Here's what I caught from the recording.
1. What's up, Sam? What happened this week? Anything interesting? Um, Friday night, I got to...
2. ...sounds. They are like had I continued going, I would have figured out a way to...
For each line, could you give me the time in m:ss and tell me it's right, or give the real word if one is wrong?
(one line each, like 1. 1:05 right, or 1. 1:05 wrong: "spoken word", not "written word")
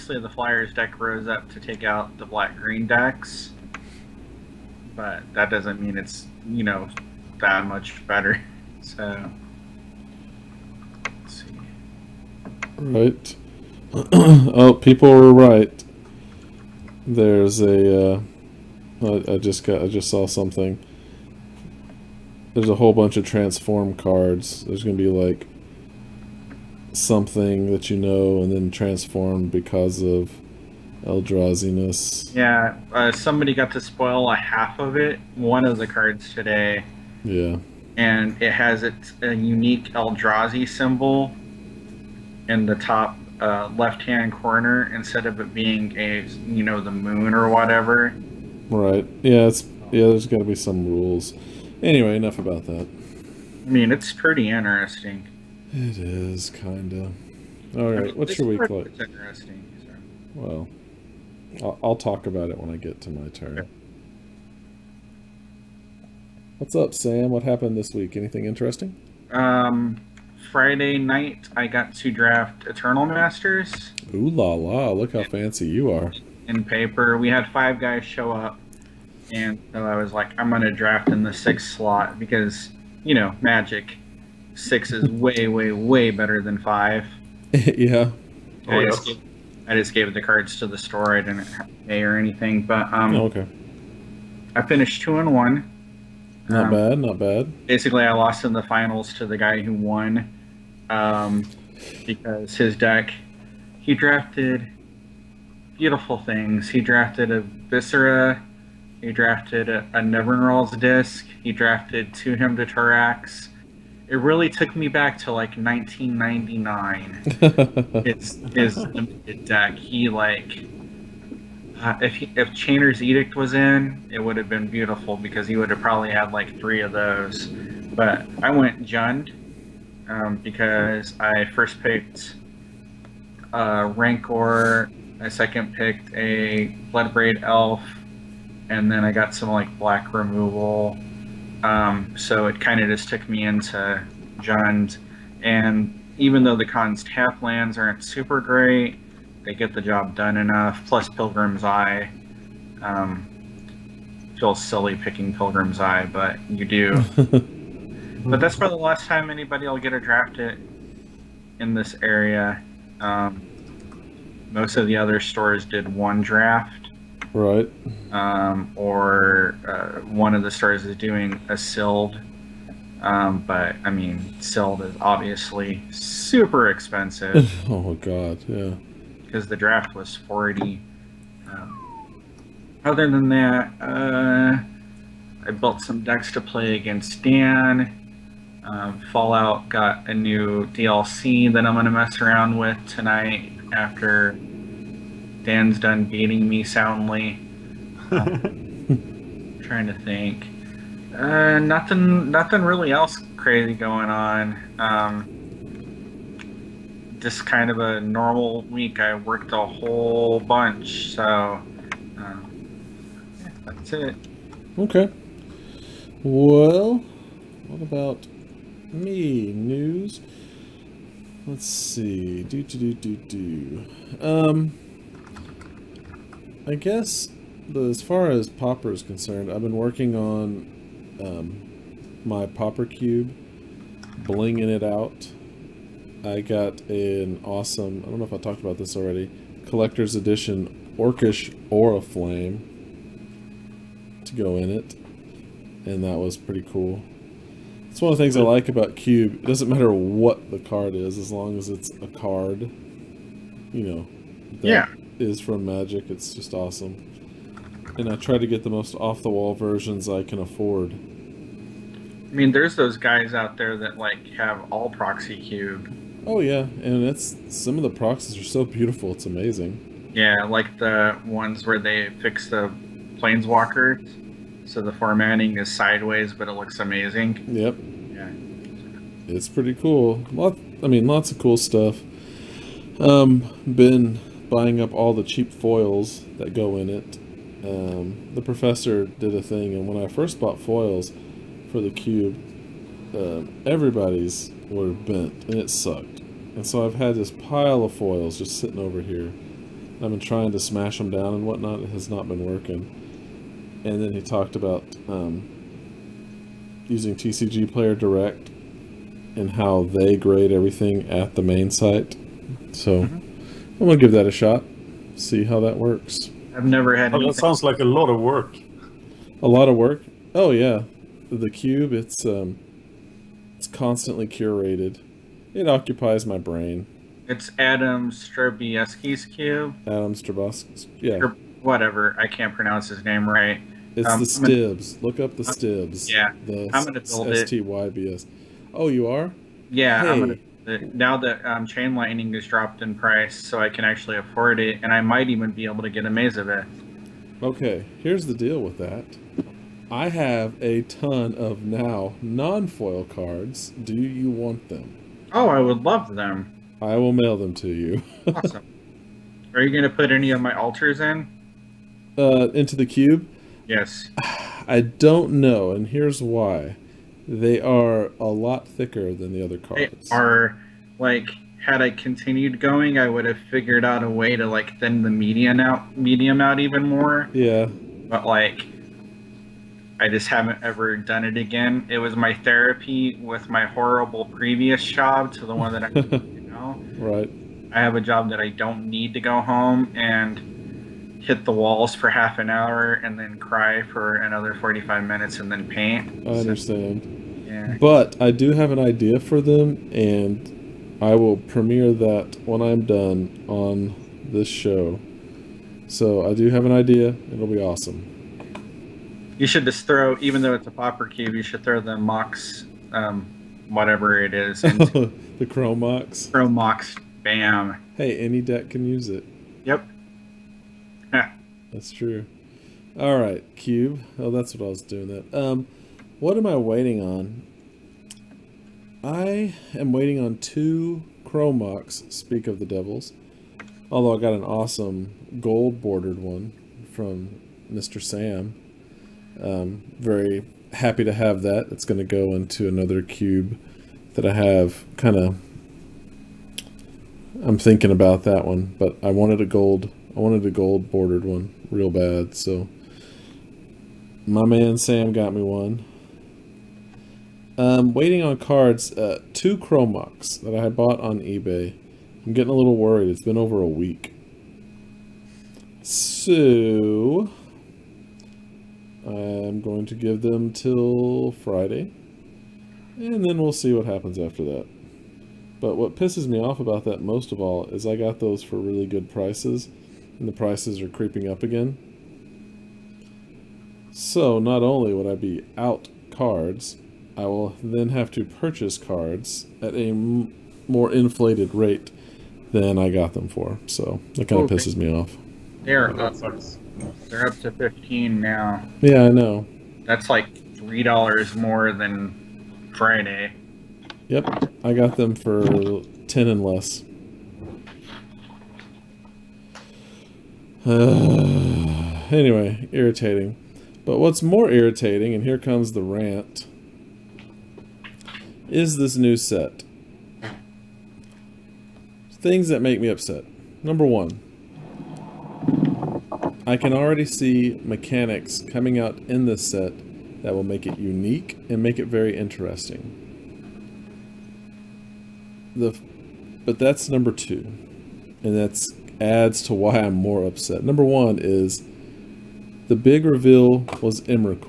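1. 1:06 right
2. 6:09 wrong: "cards", not "sounds".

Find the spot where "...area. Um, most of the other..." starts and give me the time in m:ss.
2:42.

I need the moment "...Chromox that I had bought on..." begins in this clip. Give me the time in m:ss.
7:39.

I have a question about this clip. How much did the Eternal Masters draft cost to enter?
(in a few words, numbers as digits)
$40.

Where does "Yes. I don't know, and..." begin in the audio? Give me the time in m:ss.
6:03.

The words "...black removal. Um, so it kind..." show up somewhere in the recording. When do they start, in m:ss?
2:19.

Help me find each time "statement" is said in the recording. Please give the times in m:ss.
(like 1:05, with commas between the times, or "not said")
not said.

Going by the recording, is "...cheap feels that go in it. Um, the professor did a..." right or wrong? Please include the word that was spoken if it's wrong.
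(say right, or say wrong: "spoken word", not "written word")
wrong: "foils", not "feels".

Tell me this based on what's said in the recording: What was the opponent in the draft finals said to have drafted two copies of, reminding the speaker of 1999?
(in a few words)
Hymn to Tourach.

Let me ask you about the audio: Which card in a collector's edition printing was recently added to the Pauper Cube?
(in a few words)
Orcish Oriflamme.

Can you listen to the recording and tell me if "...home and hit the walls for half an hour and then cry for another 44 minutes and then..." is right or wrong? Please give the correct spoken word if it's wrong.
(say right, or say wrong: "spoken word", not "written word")
wrong: "45", not "44".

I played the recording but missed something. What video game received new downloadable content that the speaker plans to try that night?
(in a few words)
Fallout.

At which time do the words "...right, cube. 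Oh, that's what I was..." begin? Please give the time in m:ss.
7:03.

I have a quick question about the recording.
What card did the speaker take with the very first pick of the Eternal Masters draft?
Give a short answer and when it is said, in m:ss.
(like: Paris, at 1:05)
Rancor, at 2:13.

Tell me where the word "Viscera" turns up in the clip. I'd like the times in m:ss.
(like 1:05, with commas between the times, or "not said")
1:47.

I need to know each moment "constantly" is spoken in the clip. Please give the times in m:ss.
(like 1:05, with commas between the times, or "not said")
5:23.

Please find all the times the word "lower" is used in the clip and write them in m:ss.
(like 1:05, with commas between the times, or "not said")
not said.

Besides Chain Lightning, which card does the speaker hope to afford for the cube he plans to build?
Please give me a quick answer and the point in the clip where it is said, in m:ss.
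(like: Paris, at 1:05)
Maze of Ith, at 5:46.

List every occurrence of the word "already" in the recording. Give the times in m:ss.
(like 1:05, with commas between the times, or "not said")
3:58, 8:46.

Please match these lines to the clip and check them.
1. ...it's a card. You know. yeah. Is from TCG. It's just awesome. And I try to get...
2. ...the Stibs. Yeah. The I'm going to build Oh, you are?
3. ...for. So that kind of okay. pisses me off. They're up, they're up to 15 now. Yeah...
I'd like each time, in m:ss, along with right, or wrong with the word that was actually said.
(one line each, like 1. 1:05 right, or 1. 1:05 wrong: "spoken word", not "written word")
1. 4:11 wrong: "Magic", not "TCG"
2. 5:35 right
3. 8:13 right.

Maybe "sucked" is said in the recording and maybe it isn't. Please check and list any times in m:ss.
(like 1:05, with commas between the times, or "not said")
4:55.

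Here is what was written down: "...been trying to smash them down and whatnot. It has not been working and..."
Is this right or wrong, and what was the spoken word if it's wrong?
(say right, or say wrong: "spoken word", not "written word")
right.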